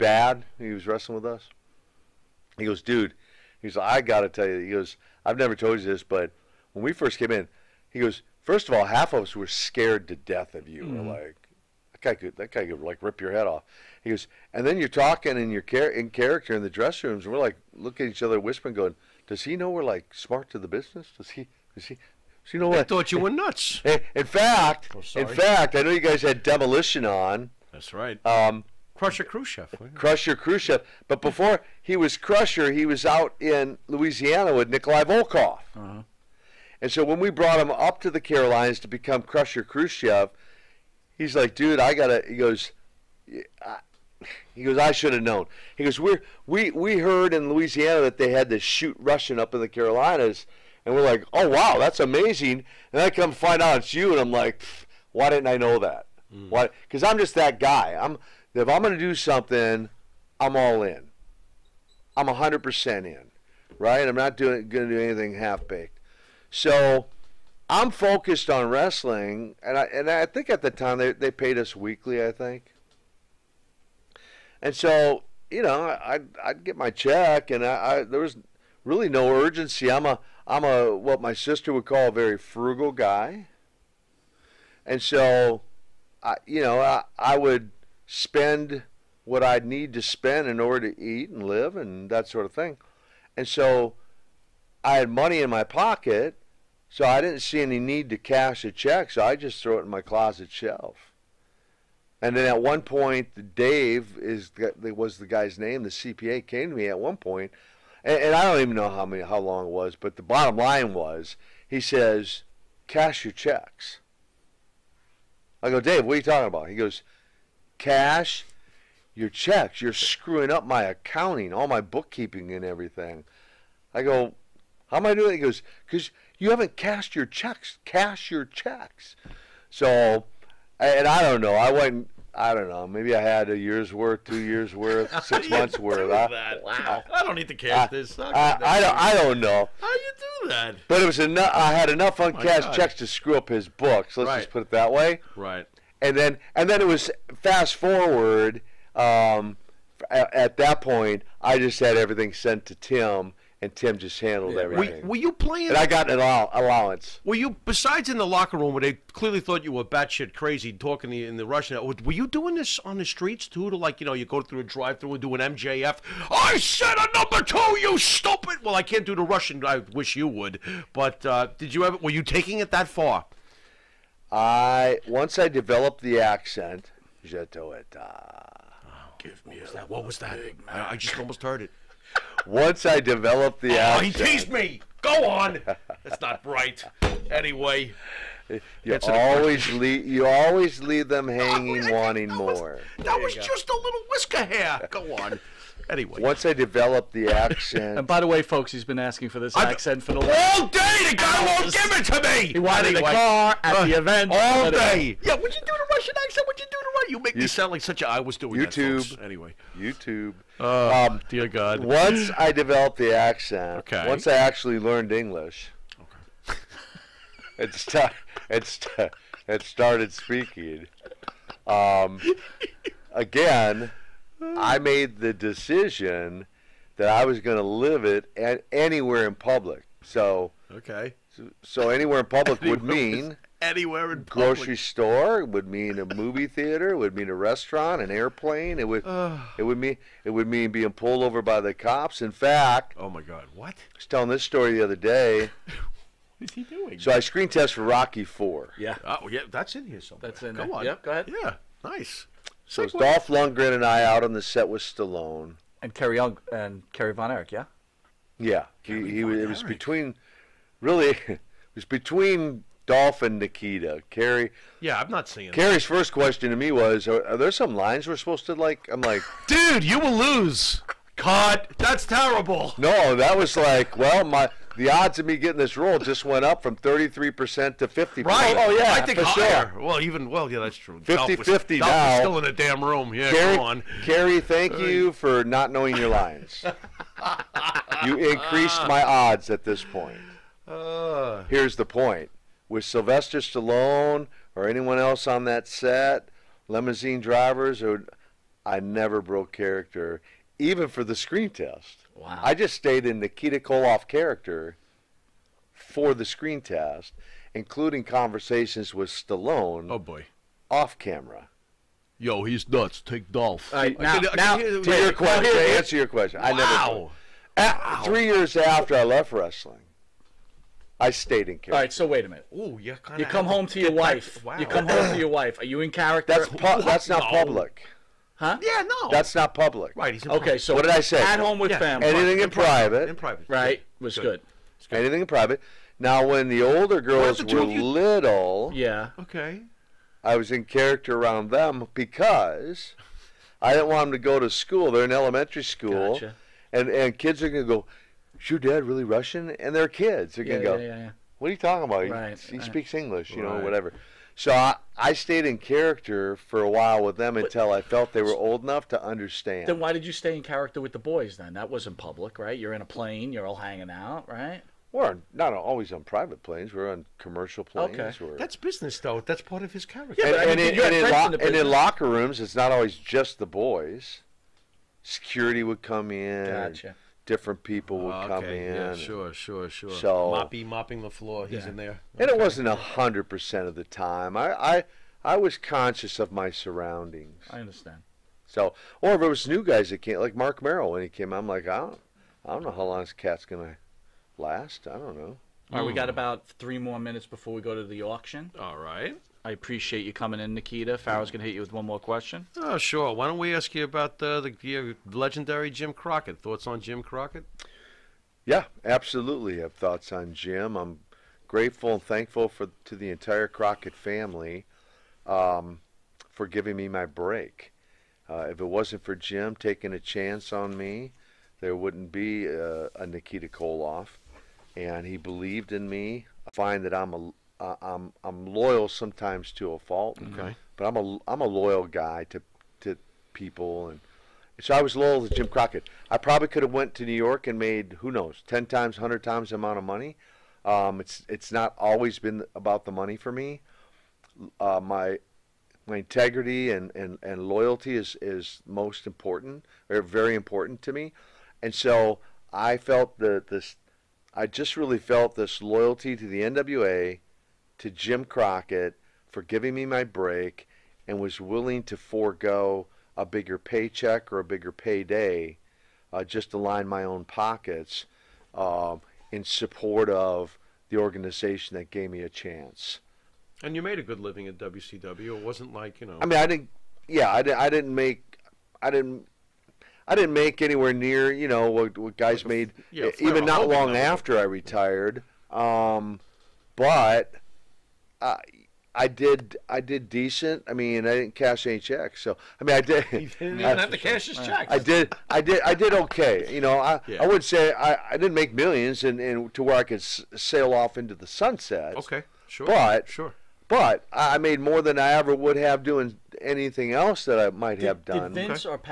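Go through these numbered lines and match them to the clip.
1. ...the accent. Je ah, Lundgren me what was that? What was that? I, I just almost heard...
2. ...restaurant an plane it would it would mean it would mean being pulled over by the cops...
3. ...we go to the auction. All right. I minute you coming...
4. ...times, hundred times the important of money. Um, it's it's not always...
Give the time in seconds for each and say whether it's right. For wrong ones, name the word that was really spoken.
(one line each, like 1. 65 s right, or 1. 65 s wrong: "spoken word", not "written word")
1. 176 s wrong: "Give", not "Lundgren"
2. 237 s wrong: "airplane", not "plane"
3. 397 s wrong: "appreciate", not "minute"
4. 438 s wrong: "amount", not "important".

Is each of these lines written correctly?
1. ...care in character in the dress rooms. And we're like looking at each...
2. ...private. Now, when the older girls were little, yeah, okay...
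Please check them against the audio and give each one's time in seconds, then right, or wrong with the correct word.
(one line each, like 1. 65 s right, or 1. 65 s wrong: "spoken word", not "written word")
1. 15 s right
2. 335 s right.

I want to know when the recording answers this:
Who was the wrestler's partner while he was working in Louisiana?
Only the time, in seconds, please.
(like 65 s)
34 s.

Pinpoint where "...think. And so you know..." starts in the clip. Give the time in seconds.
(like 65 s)
72 s.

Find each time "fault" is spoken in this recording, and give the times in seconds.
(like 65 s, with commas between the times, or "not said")
429 s.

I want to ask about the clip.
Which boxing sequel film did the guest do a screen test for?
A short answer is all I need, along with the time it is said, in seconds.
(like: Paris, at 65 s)
Rocky 4, at 247 s.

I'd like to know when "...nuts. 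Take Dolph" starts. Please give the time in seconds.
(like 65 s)
312 s.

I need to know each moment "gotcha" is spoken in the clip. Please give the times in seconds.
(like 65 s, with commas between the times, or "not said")
346 s, 376 s.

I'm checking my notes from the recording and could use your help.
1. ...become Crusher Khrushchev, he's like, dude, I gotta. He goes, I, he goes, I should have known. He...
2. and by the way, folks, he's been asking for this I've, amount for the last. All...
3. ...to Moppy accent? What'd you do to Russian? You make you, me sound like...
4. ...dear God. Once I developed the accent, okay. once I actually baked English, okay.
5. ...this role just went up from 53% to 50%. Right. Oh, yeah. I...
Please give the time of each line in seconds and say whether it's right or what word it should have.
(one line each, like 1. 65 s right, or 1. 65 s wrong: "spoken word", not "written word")
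1. 38 s right
2. 197 s wrong: "accent", not "amount"
3. 205 s wrong: "Russian", not "Moppy"
4. 211 s wrong: "learned", not "baked"
5. 275 s wrong: "33", not "53".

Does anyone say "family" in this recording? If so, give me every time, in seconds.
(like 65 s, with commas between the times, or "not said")
331 s, 413 s.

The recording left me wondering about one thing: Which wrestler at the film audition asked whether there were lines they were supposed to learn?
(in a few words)
Kerry Von Erich.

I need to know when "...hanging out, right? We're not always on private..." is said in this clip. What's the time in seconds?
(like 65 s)
363 s.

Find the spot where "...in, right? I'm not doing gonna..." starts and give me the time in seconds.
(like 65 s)
63 s.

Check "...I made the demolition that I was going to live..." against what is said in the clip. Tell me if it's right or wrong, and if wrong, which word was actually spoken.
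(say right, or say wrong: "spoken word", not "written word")
wrong: "decision", not "demolition".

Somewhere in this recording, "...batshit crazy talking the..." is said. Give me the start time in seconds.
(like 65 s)
159 s.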